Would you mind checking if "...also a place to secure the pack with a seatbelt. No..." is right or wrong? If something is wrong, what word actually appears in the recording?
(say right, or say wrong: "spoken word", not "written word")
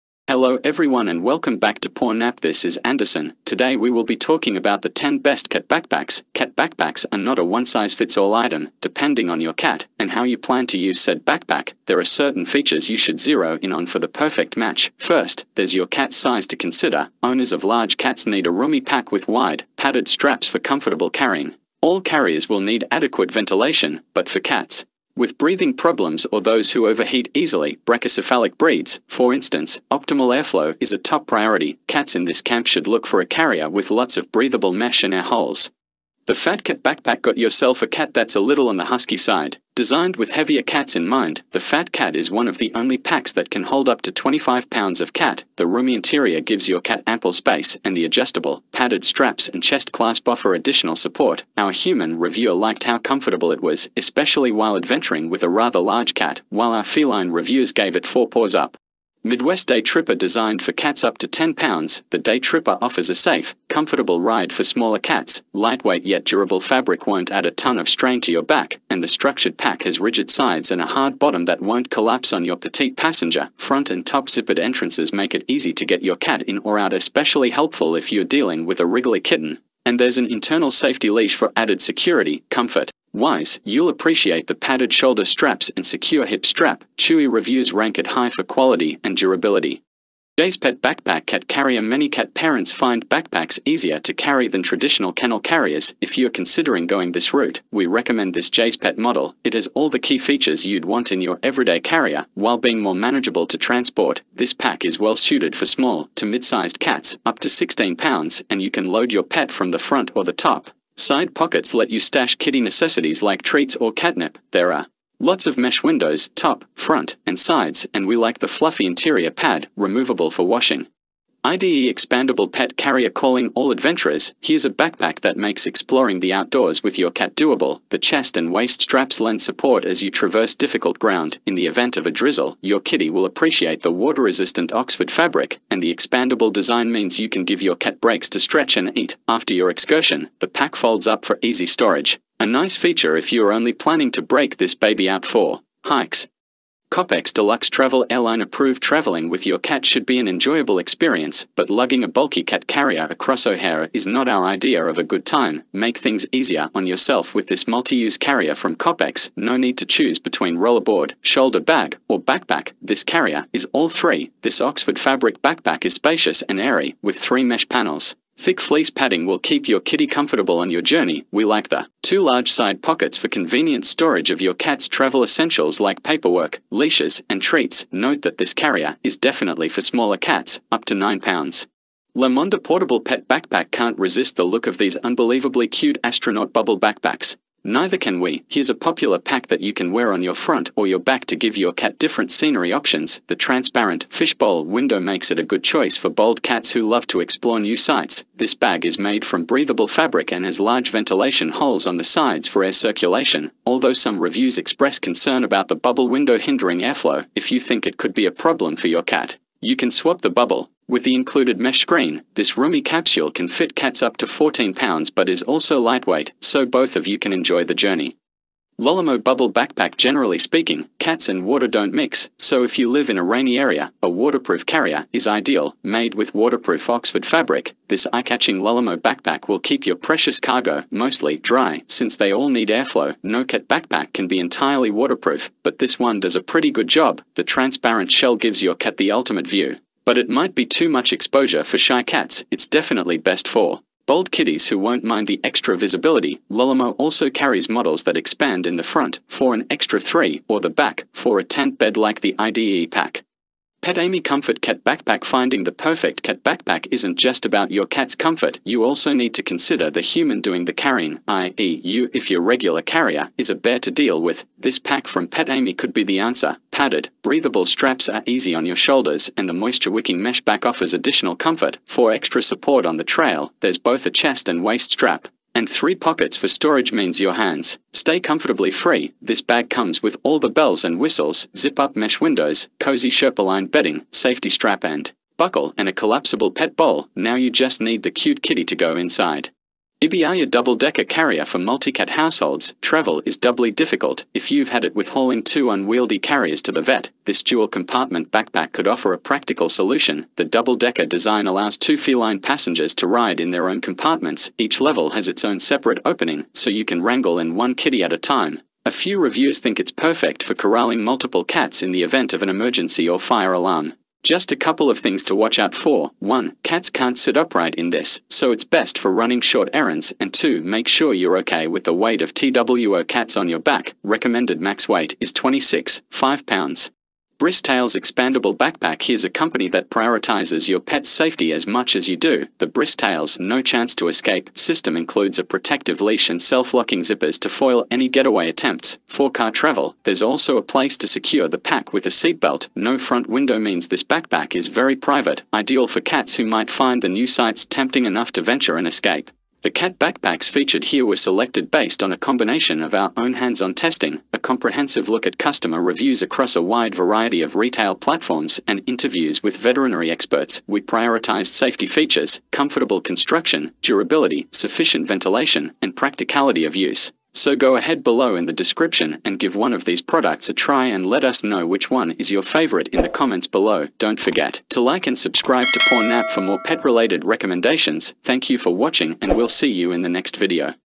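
right.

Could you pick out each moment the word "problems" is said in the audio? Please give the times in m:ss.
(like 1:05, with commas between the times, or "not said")
0:25, 3:28.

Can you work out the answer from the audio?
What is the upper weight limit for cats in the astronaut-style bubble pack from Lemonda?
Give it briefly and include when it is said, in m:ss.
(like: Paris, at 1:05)
14 pounds, at 3:34.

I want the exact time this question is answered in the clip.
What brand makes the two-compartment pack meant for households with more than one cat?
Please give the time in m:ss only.
4:50.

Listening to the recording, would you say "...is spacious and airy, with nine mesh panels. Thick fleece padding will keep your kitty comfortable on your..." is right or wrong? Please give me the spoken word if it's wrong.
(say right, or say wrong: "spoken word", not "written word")
wrong: "three", not "nine".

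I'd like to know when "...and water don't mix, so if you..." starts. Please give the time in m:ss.
3:41.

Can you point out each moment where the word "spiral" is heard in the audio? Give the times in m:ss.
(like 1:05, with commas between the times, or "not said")
not said.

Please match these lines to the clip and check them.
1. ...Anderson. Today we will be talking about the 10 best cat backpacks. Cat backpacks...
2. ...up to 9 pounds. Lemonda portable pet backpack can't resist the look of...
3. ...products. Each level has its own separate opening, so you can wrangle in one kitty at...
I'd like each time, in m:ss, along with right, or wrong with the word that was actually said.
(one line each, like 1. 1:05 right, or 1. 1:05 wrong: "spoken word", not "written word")
1. 0:02 right
2. 3:00 right
3. 5:03 wrong: "compartments", not "products".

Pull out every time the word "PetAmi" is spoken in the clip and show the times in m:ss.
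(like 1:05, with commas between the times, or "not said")
4:13, 4:25.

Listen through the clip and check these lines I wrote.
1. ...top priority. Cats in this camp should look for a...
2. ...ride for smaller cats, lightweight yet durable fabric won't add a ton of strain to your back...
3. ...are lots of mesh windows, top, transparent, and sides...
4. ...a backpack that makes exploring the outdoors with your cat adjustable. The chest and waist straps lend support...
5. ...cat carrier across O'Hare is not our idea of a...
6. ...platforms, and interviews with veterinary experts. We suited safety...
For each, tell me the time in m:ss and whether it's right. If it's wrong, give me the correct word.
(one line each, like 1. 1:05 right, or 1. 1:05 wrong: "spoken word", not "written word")
1. 0:30 right
2. 1:04 right
3. 1:54 wrong: "front", not "transparent"
4. 2:04 wrong: "doable", not "adjustable"
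5. 2:32 right
6. 5:57 wrong: "prioritized", not "suited".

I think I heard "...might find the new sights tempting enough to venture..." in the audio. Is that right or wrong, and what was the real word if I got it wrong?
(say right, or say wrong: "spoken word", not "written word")
right.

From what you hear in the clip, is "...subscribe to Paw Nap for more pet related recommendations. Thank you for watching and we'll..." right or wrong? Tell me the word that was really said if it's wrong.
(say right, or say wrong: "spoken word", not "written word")
right.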